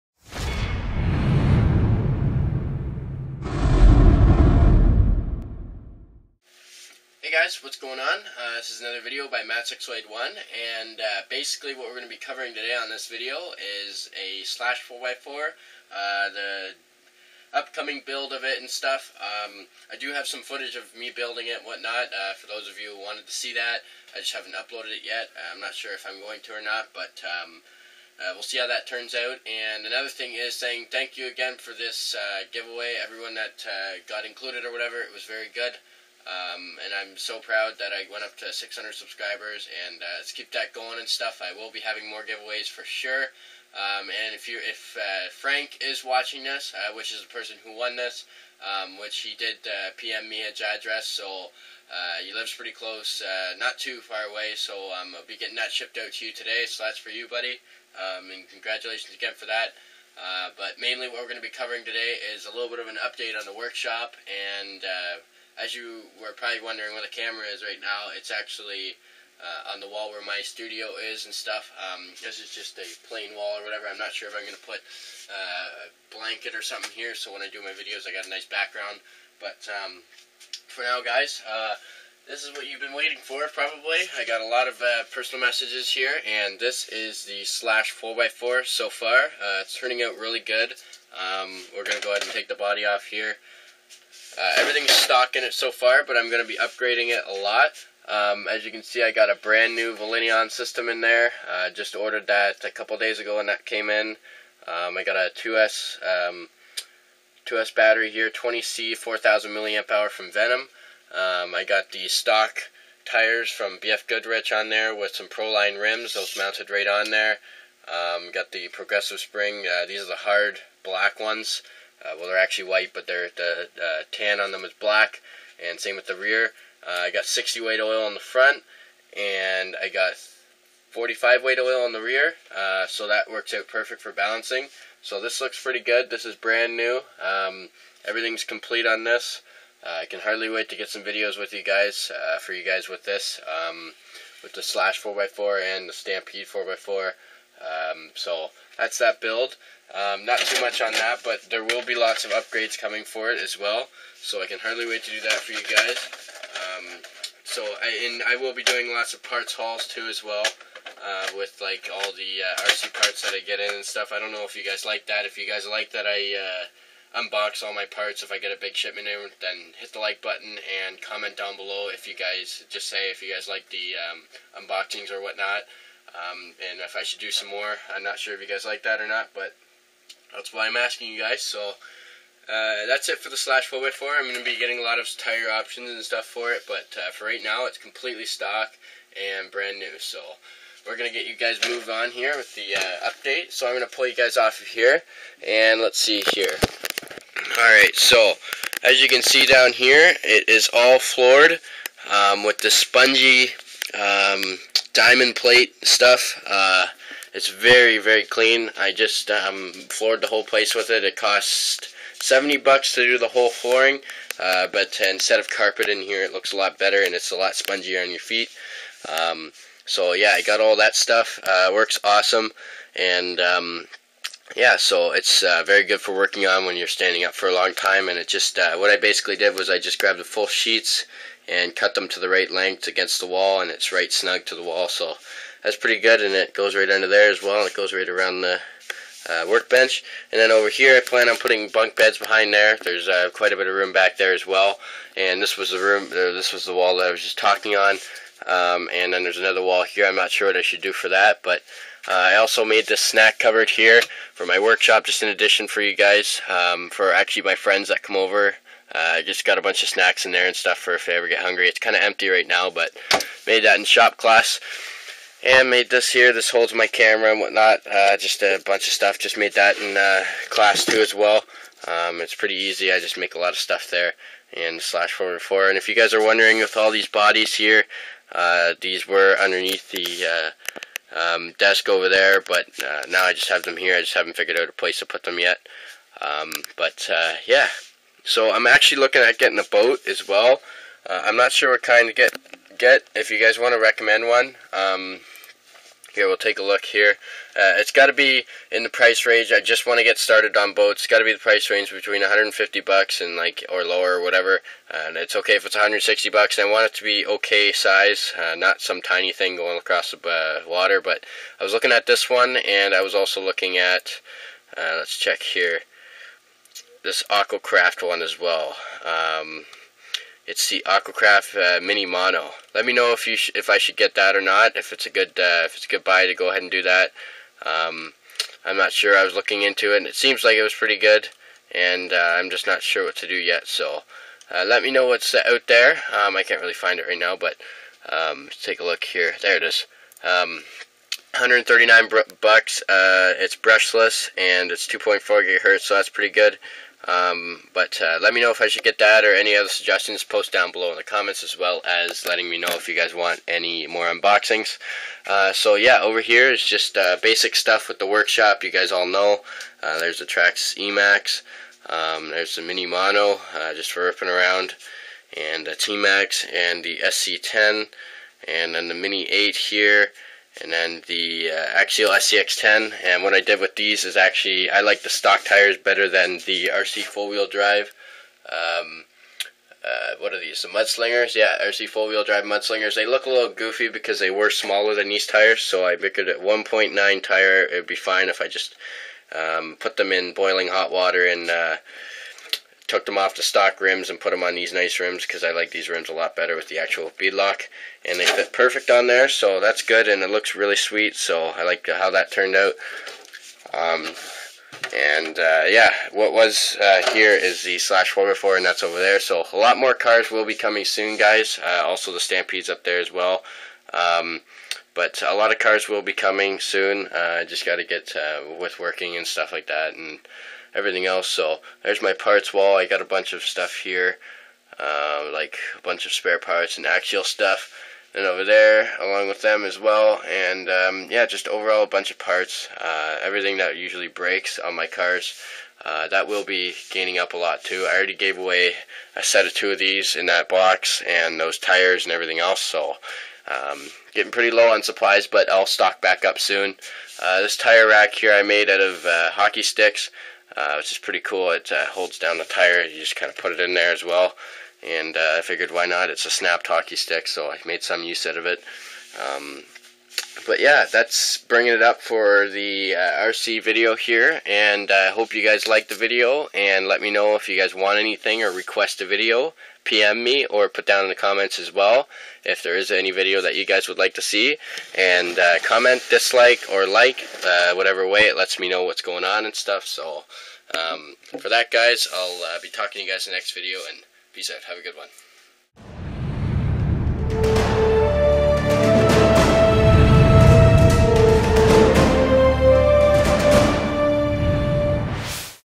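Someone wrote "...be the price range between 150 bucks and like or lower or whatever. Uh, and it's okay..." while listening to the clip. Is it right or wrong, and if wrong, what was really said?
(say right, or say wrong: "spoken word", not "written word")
right.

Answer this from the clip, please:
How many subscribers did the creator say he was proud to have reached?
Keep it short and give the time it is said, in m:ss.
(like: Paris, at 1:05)
600, at 0:38.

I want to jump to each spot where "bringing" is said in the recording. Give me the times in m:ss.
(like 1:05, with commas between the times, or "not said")
7:41.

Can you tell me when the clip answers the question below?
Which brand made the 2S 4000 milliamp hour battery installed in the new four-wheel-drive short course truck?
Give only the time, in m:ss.
1:50.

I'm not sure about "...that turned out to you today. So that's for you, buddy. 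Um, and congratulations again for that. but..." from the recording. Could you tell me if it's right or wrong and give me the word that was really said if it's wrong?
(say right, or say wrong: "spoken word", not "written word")
wrong: "shipped", not "turned".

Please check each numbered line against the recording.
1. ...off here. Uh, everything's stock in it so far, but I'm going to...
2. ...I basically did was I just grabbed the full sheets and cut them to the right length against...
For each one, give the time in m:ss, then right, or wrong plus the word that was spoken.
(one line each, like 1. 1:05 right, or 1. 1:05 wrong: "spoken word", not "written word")
1. 1:32 right
2. 3:48 right.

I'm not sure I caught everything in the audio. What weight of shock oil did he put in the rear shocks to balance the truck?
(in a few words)
45 weight.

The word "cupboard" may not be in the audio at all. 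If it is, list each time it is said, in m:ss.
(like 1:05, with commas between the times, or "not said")
4:13.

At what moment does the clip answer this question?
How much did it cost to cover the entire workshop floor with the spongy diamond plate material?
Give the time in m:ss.
3:32.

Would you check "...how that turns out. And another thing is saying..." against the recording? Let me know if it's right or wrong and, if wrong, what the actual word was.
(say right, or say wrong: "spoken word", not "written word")
right.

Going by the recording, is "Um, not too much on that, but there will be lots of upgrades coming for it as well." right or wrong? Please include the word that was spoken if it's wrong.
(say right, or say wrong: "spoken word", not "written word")
right.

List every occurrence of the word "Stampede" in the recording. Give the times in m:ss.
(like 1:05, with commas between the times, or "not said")
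2:25, 6:52.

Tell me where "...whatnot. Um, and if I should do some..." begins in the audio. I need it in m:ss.
2:55.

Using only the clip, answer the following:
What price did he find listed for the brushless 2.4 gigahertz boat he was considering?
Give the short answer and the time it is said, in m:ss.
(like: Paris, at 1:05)
139, at 5:40.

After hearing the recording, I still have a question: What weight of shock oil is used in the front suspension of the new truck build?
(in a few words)
60 weight.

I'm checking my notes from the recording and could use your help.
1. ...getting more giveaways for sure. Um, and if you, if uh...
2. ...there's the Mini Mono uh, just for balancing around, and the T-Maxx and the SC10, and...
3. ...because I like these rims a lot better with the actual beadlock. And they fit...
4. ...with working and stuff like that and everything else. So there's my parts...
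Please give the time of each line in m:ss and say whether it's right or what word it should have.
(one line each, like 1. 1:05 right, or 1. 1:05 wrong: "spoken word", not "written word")
1. 0:41 wrong: "having", not "getting"
2. 6:02 wrong: "ripping", not "balancing"
3. 6:35 right
4. 6:58 right.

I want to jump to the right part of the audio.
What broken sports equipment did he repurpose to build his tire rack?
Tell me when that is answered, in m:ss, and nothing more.
7:29.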